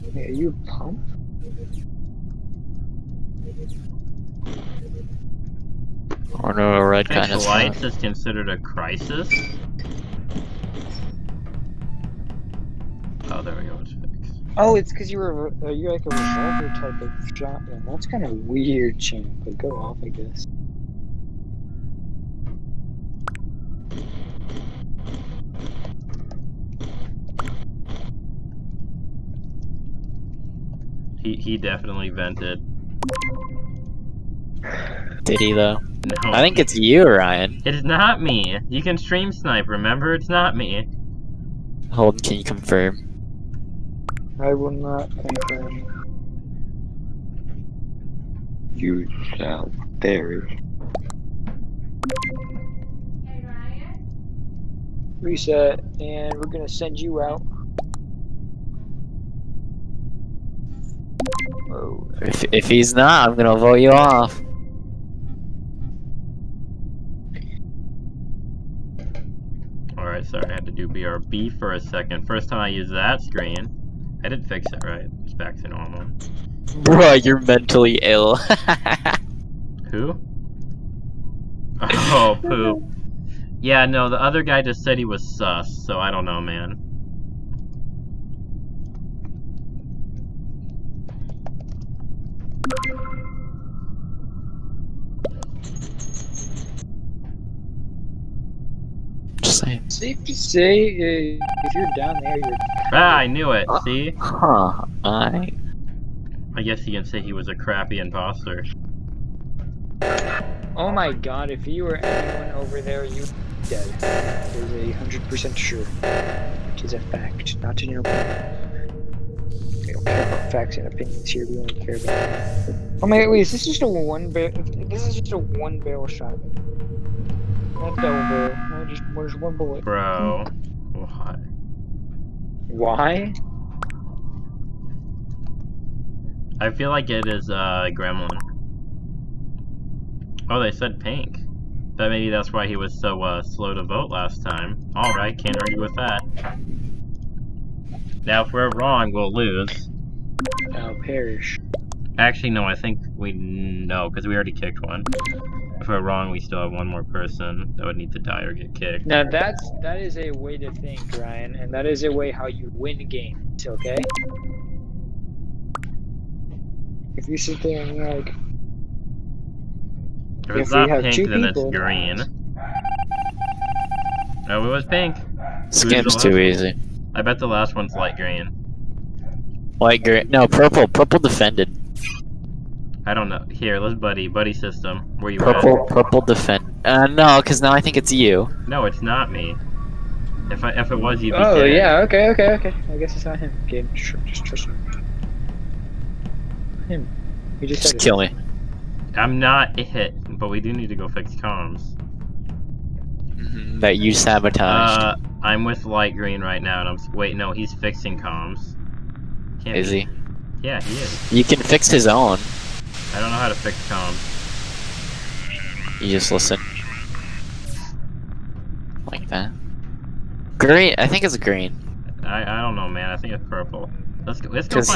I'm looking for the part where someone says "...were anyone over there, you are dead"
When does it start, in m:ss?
1:51.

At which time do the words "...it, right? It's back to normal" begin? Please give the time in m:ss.
1:14.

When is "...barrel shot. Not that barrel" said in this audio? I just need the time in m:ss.
2:05.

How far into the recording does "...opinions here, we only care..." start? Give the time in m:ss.
2:00.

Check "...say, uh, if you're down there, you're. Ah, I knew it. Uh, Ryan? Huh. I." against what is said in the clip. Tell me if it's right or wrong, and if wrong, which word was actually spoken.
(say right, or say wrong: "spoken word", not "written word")
wrong: "See", not "Ryan".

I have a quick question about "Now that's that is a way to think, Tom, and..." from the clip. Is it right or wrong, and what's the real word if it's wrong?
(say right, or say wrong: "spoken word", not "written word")
wrong: "Ryan", not "Tom".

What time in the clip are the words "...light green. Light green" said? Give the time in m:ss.
2:57.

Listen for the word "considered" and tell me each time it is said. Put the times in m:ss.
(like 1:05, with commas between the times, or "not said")
0:07.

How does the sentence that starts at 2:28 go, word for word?
Now, if we're wrong, we'll lose.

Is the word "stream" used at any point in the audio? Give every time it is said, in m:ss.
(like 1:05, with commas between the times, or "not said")
0:38.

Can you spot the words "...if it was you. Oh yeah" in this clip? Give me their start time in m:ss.
3:10.